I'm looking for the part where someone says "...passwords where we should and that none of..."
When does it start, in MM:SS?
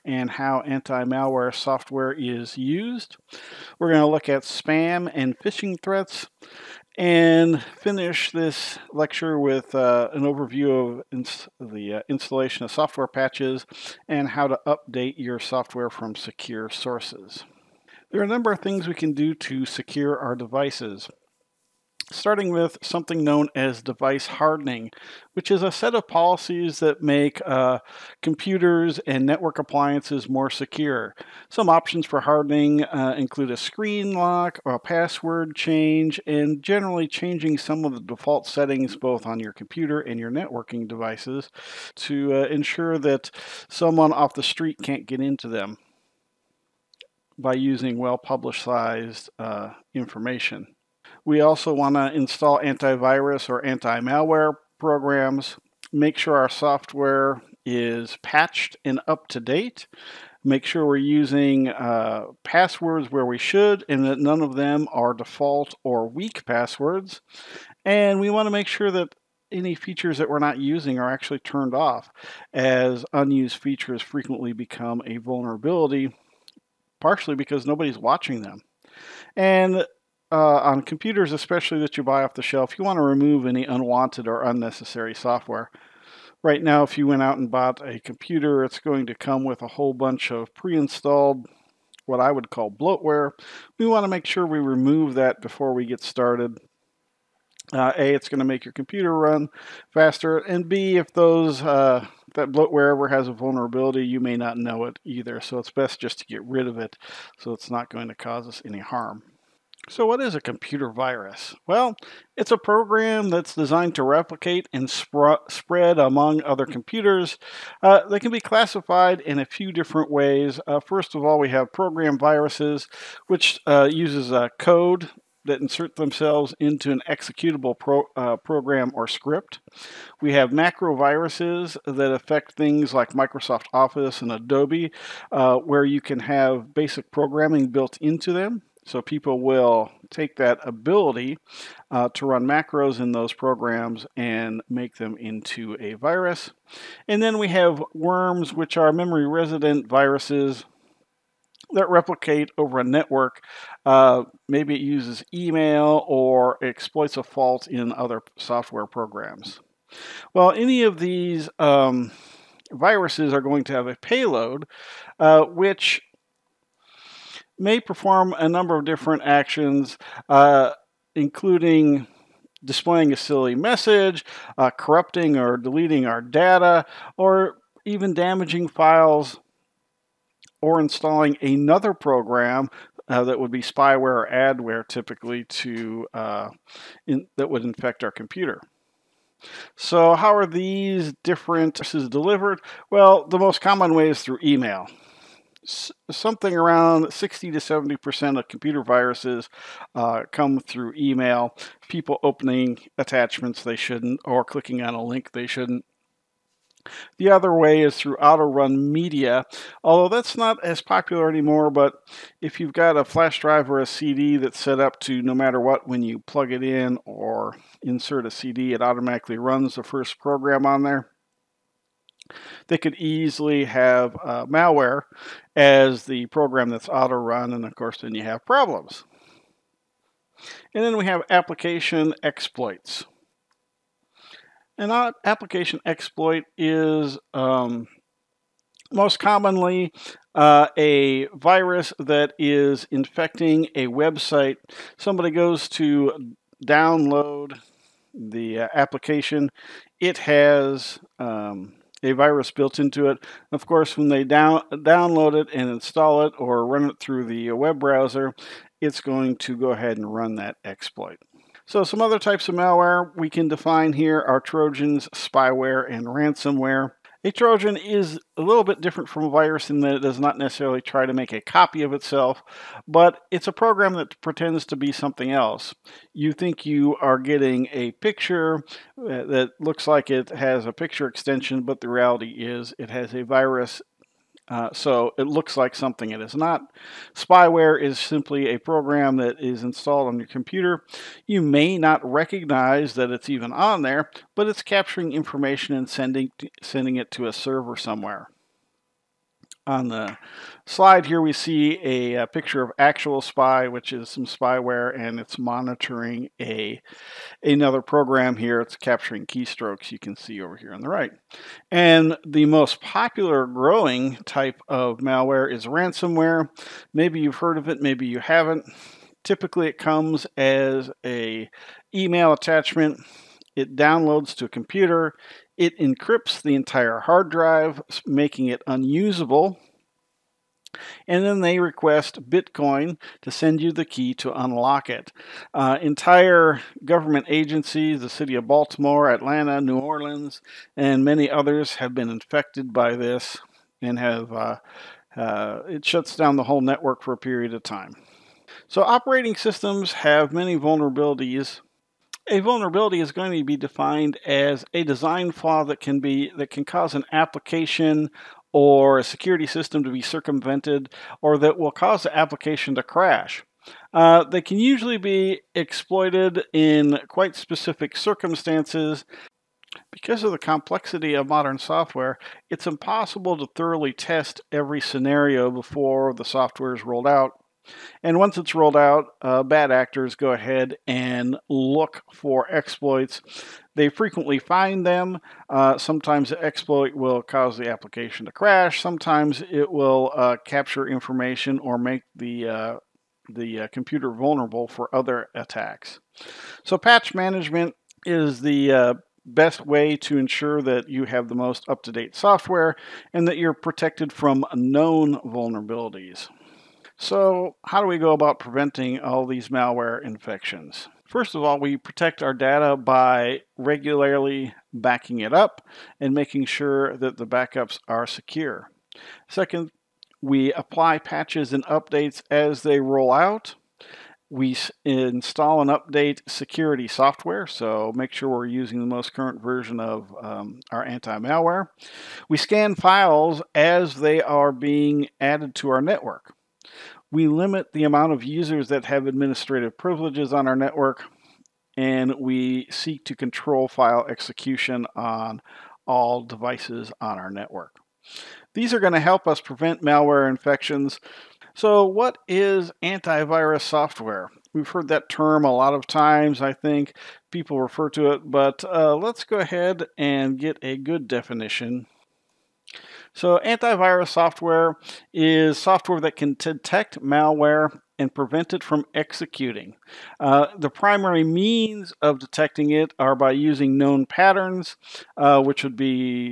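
01:02.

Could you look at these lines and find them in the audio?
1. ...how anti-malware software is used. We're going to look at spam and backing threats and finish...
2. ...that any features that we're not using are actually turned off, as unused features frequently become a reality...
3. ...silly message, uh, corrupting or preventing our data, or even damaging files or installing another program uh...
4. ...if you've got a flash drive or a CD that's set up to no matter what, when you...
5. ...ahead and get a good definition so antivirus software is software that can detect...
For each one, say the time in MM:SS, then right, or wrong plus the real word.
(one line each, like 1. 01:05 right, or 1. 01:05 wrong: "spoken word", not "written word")
1. 00:00 wrong: "phishing", not "backing"
2. 01:08 wrong: "vulnerability", not "reality"
3. 02:53 wrong: "deleting", not "preventing"
4. 03:32 right
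5. 07:39 right.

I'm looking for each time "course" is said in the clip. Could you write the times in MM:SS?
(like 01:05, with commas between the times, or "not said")
03:47, 04:13.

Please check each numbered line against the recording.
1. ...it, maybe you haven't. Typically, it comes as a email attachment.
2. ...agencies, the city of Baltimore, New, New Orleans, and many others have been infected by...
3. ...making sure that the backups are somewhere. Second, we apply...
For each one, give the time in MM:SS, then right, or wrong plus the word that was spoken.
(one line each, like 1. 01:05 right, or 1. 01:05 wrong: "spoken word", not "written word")
1. 05:17 right
2. 05:37 wrong: "Atlanta", not "New"
3. 06:56 wrong: "secure", not "somewhere".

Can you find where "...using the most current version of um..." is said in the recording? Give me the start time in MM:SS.
07:08.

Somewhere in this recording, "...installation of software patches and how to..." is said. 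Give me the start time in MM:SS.
00:12.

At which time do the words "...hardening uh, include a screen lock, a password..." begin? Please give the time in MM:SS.
00:32.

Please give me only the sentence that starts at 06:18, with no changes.
And once it's rolled out, uh, bad actors go ahead and look for exploits.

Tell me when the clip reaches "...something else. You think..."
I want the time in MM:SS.
04:34.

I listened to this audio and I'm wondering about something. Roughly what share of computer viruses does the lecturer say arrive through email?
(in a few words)
60 to 70 percent.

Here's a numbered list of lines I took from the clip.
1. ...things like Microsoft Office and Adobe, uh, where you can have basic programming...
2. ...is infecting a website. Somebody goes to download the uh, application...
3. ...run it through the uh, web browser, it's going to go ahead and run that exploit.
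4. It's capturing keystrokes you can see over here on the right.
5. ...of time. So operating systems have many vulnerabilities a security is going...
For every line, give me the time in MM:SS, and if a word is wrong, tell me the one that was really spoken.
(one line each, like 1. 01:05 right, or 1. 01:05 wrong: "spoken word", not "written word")
1. 02:12 right
2. 04:02 right
3. 04:16 right
4. 05:08 right
5. 05:47 wrong: "vulnerability", not "security".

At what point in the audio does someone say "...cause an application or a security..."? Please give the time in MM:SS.
05:56.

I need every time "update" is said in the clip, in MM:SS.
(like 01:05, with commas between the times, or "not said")
00:14, 07:01, 07:05.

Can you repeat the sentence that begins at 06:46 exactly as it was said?
So how do we go about preventing all these malware infections?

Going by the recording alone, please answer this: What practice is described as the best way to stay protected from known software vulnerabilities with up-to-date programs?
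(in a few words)
patch management.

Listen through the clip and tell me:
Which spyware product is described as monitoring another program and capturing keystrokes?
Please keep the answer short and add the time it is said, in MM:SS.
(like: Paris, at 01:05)
Actual Spy, at 05:02.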